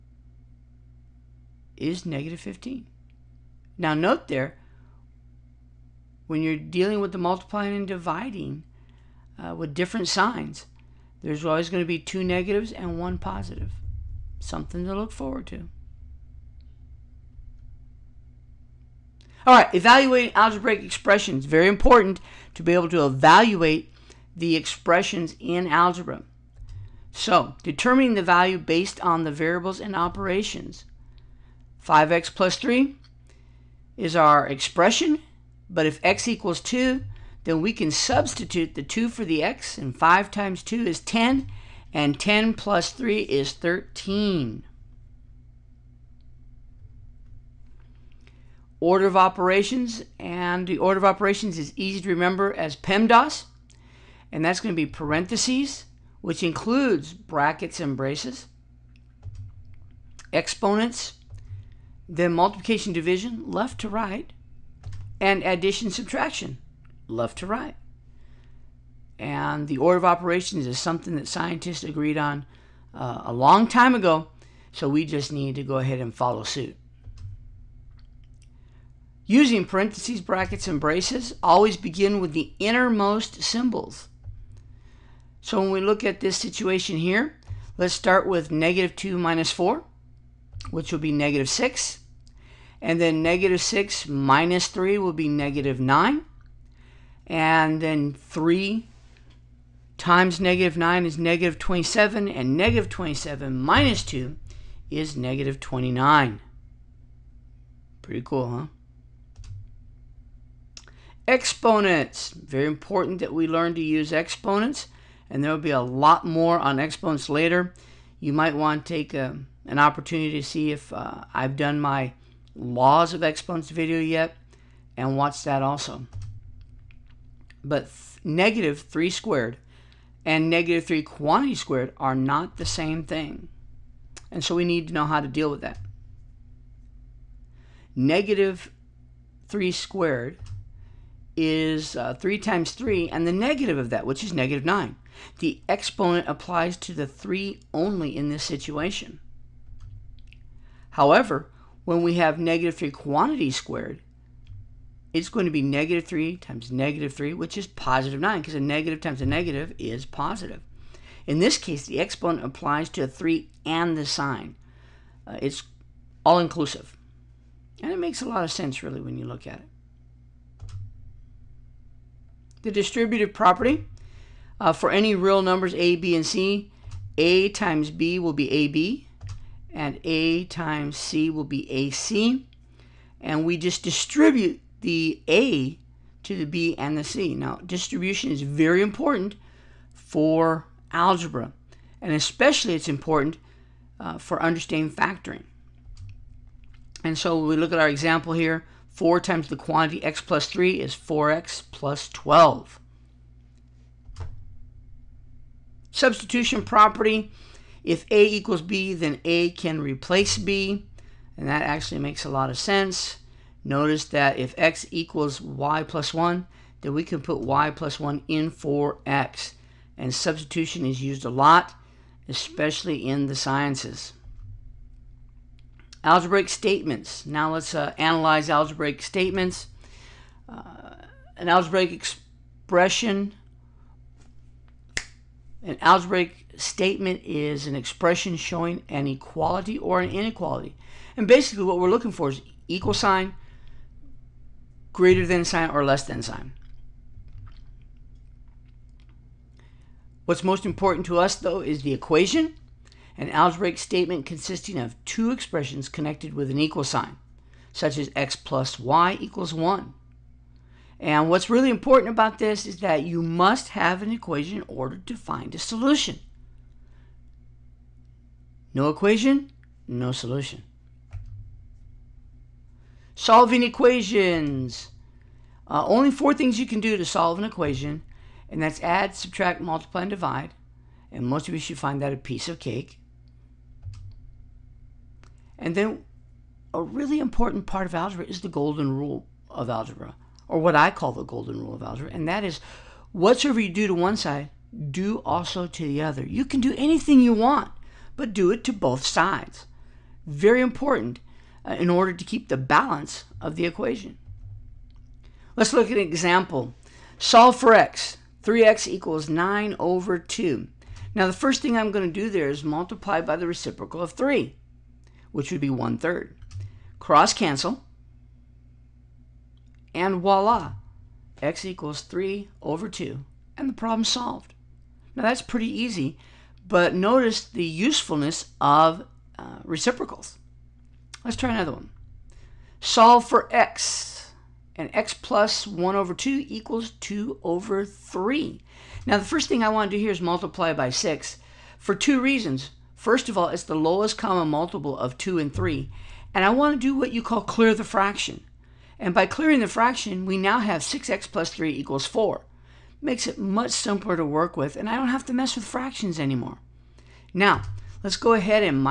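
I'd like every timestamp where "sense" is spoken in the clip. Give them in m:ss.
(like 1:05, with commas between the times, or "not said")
2:48, 3:32.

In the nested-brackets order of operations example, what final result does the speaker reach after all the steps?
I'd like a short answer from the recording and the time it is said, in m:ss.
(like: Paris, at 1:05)
-29, at 1:45.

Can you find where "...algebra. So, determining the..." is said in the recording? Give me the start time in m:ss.
0:25.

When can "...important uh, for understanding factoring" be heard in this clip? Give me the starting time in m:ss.
3:12.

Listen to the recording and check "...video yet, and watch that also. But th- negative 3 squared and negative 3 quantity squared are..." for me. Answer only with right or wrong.
right.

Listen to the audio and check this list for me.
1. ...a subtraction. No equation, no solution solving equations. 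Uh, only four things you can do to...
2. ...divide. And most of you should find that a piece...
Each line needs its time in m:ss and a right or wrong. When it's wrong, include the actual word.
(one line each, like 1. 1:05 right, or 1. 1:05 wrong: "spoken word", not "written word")
1. 4:25 wrong: "solution", not "subtraction"
2. 4:40 right.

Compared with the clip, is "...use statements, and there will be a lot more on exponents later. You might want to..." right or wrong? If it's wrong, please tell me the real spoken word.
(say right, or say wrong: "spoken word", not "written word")
wrong: "exponents", not "statements".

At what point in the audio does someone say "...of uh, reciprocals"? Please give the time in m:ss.
5:28.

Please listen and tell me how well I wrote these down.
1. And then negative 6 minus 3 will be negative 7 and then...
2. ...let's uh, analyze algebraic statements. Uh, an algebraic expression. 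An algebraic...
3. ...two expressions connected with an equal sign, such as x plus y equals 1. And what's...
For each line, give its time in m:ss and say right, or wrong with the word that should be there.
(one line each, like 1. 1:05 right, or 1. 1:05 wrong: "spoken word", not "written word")
1. 1:32 wrong: "9", not "7"
2. 3:47 right
3. 4:15 right.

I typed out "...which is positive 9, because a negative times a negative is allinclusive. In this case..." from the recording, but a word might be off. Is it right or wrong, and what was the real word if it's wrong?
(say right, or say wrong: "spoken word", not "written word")
wrong: "positive", not "allinclusive".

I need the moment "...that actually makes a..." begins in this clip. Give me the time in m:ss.
3:31.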